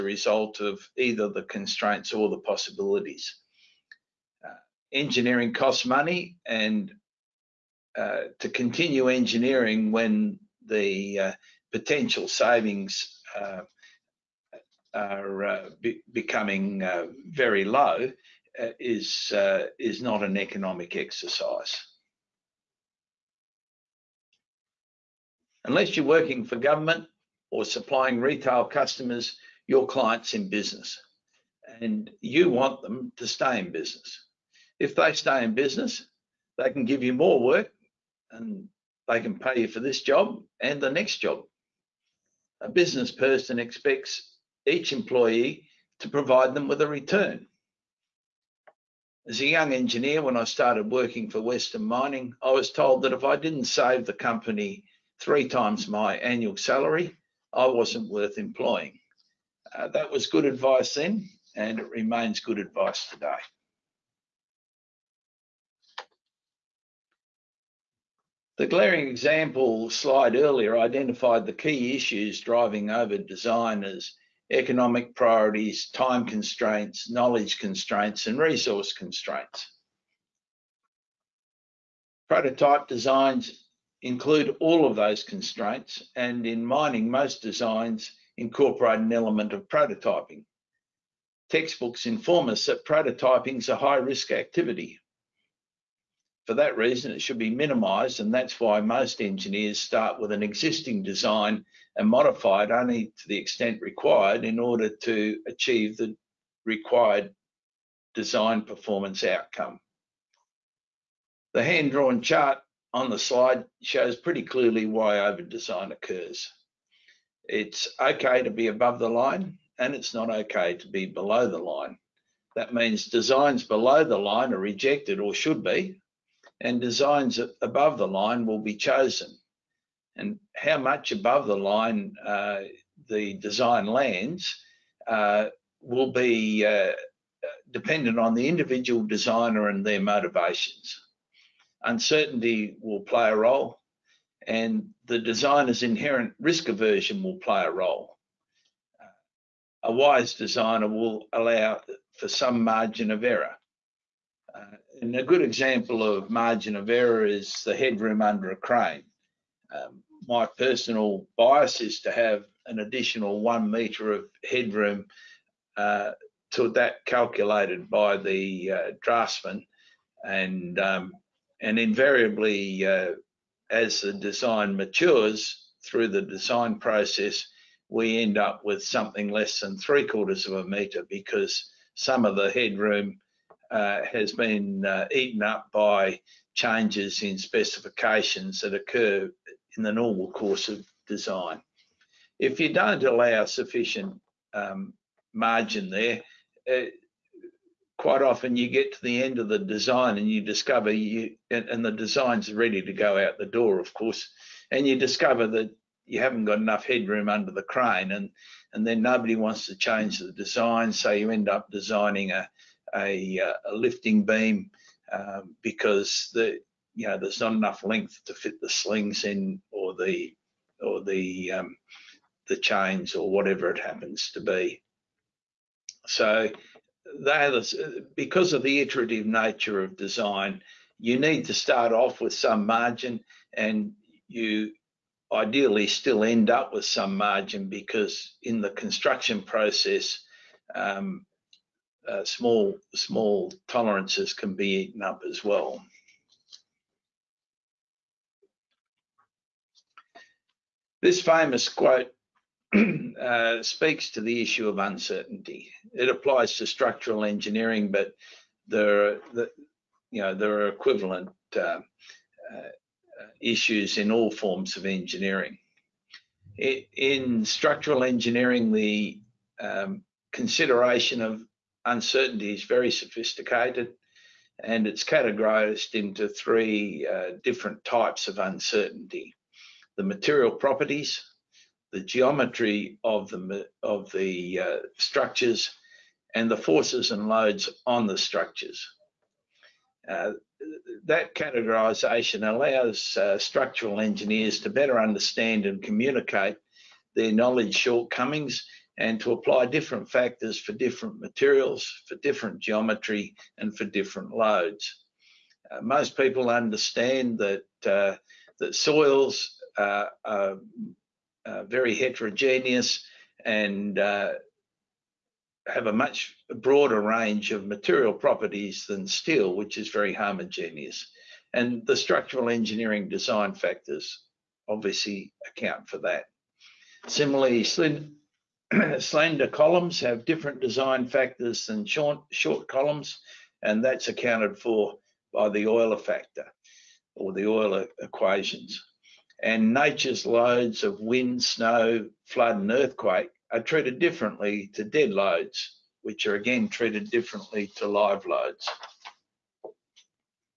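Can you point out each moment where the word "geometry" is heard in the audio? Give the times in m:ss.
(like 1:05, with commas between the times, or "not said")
4:42, 5:02.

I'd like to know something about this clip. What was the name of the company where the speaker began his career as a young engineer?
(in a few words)
Western Mining.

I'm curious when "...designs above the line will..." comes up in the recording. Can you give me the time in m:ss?
2:06.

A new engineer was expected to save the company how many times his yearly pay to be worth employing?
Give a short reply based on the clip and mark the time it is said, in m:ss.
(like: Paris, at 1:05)
3, at 0:55.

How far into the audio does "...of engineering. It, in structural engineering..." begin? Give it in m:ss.
4:24.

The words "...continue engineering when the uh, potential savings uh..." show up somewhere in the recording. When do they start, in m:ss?
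0:08.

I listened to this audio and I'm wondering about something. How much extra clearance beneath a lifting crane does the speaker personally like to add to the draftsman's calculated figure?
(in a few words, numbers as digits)
1 metre.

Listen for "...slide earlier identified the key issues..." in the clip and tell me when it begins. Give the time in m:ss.
1:09.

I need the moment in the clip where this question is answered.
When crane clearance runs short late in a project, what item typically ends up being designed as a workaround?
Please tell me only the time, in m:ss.
3:33.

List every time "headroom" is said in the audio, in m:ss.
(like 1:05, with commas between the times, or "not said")
2:37, 2:44, 3:02, 3:26.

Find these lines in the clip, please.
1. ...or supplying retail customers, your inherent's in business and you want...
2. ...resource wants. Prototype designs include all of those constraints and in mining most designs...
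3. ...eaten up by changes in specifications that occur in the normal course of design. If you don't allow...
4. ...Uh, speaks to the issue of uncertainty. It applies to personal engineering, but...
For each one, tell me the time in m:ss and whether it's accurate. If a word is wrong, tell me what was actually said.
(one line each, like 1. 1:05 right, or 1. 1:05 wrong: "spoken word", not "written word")
1. 0:27 wrong: "client", not "inherent"
2. 1:18 wrong: "constraints", not "wants"
3. 3:05 right
4. 4:13 wrong: "structural", not "personal".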